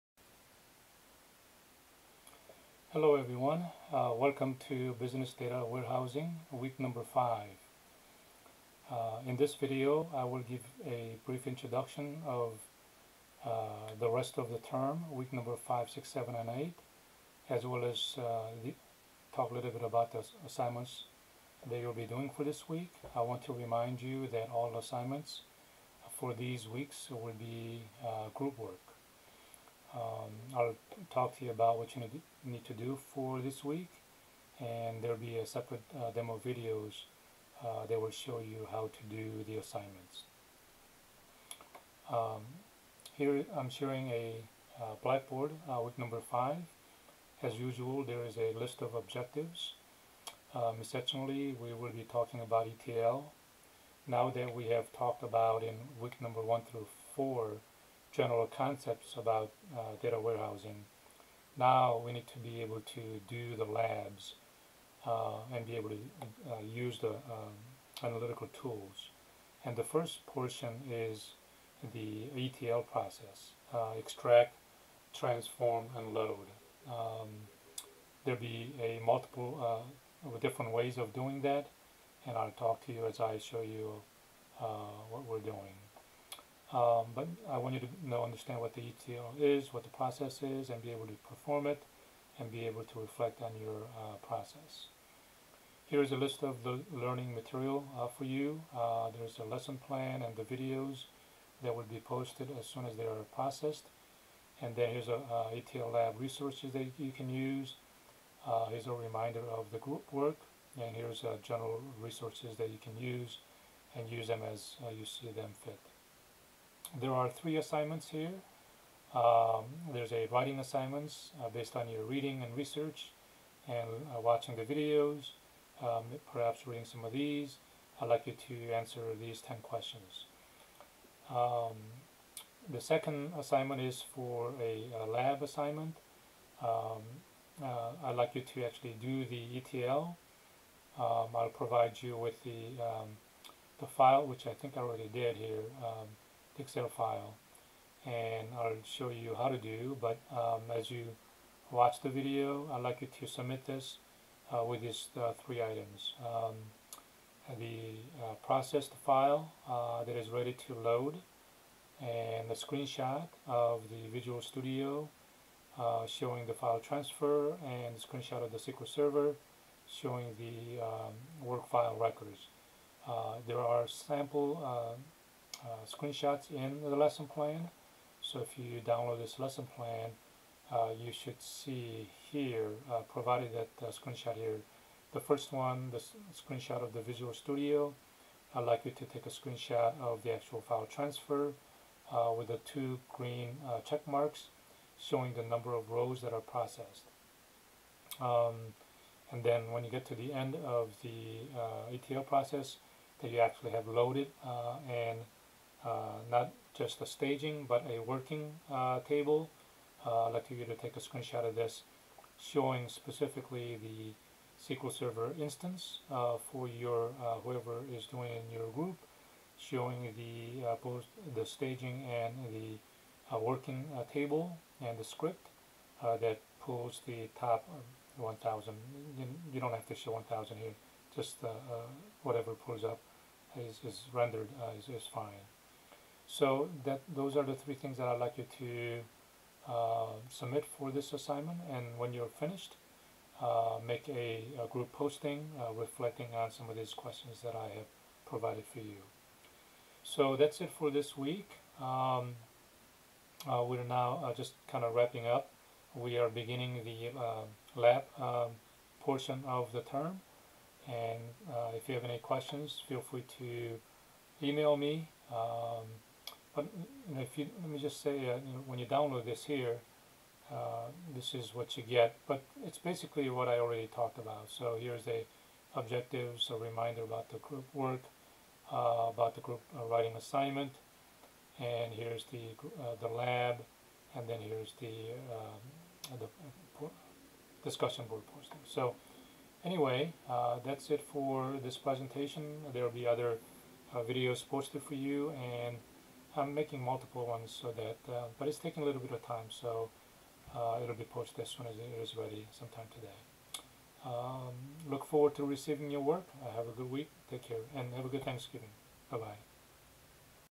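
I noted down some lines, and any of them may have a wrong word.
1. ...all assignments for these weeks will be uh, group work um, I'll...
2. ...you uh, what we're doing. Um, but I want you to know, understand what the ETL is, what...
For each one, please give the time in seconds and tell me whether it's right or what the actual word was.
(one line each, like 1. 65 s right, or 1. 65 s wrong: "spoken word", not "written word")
1. 24 s right
2. 83 s right.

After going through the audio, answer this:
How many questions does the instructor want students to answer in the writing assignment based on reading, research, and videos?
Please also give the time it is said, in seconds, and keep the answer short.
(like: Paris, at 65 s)
10, at 129 s.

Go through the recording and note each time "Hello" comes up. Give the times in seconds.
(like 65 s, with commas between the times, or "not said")
2 s.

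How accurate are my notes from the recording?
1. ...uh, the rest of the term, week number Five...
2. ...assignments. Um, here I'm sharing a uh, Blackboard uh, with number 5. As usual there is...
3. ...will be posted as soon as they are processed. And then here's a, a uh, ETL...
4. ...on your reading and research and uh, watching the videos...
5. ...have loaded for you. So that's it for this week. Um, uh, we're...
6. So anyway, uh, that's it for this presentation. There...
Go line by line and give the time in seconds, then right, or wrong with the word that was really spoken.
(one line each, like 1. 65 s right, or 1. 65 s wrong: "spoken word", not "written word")
1. 13 s right
2. 39 s right
3. 101 s right
4. 121 s right
5. 247 s wrong: "provided", not "loaded"
6. 288 s right.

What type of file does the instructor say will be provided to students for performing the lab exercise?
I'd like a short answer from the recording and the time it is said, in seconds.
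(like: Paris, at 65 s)
Excel file, at 146 s.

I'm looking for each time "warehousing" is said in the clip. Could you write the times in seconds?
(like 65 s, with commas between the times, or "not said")
5 s, 60 s.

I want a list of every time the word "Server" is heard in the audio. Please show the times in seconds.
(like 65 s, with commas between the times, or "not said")
168 s, 214 s.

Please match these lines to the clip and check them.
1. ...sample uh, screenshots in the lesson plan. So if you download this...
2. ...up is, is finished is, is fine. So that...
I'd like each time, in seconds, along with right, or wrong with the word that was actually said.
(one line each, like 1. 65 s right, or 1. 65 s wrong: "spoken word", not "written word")
1. 173 s right
2. 232 s wrong: "rendered", not "finished".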